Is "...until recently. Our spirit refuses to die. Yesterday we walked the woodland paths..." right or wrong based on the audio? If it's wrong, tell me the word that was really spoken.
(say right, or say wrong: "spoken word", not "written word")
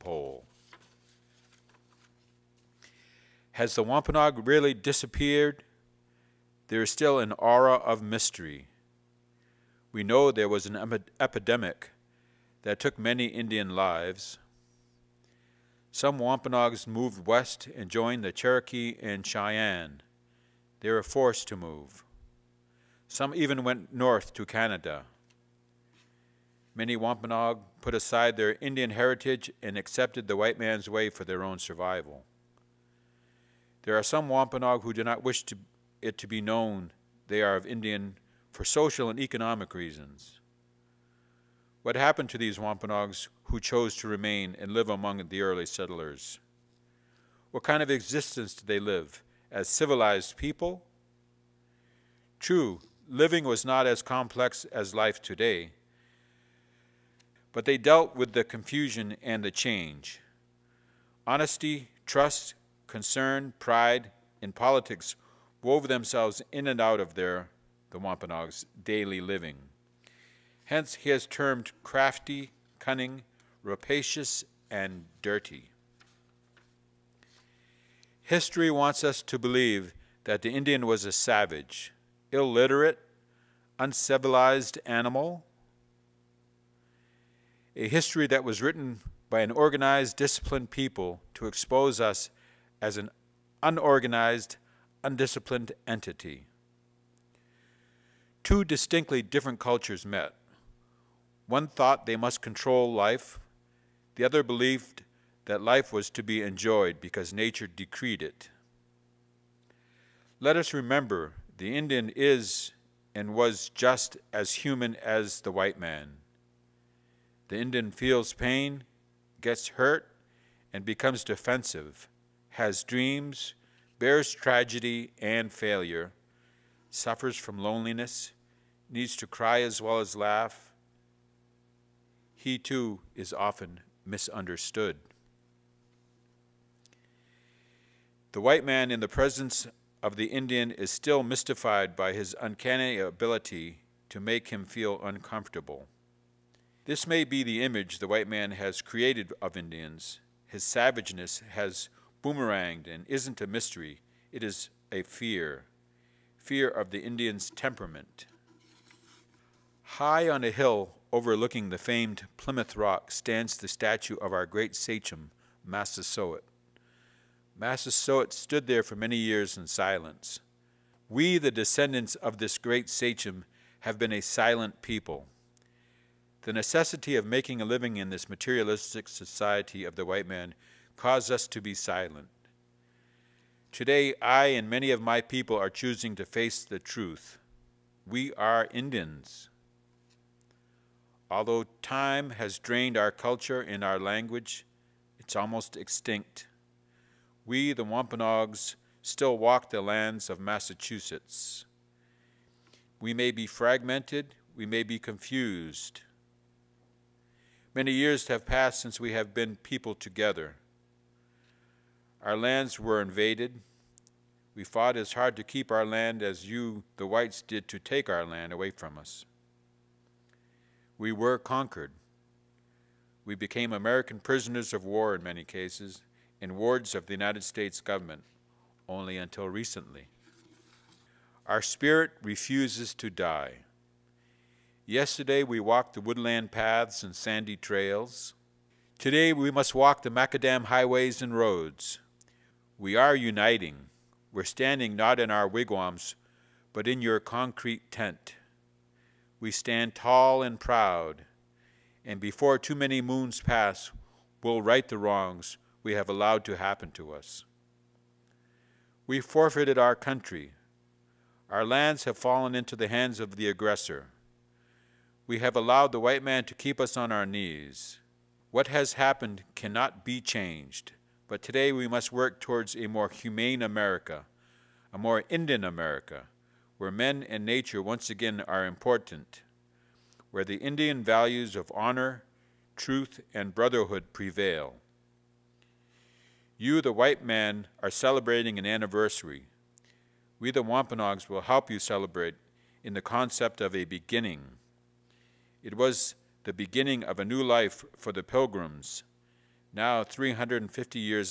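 right.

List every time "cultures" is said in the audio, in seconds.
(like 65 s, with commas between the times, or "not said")
99 s, 193 s.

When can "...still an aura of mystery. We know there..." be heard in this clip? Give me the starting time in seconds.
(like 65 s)
6 s.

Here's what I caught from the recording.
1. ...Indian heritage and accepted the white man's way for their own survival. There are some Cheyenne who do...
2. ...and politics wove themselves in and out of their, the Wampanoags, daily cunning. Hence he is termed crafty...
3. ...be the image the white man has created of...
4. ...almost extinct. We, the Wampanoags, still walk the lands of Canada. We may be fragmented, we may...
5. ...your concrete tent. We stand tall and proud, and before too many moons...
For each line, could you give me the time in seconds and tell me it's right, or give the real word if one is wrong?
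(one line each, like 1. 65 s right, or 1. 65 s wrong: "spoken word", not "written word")
1. 28 s wrong: "Wampanoag", not "Cheyenne"
2. 64 s wrong: "living", not "cunning"
3. 147 s right
4. 195 s wrong: "Massachusetts", not "Canada"
5. 247 s right.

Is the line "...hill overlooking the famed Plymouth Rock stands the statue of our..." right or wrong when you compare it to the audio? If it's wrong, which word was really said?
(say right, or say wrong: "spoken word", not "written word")
right.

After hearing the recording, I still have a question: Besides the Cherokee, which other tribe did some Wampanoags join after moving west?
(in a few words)
Cheyenne.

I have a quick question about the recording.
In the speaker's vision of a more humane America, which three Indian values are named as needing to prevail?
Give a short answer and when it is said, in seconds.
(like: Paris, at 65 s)
honor, truth, and brotherhood, at 281 s.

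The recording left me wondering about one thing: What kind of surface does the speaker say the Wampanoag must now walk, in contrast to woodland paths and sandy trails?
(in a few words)
macadam highways and roads.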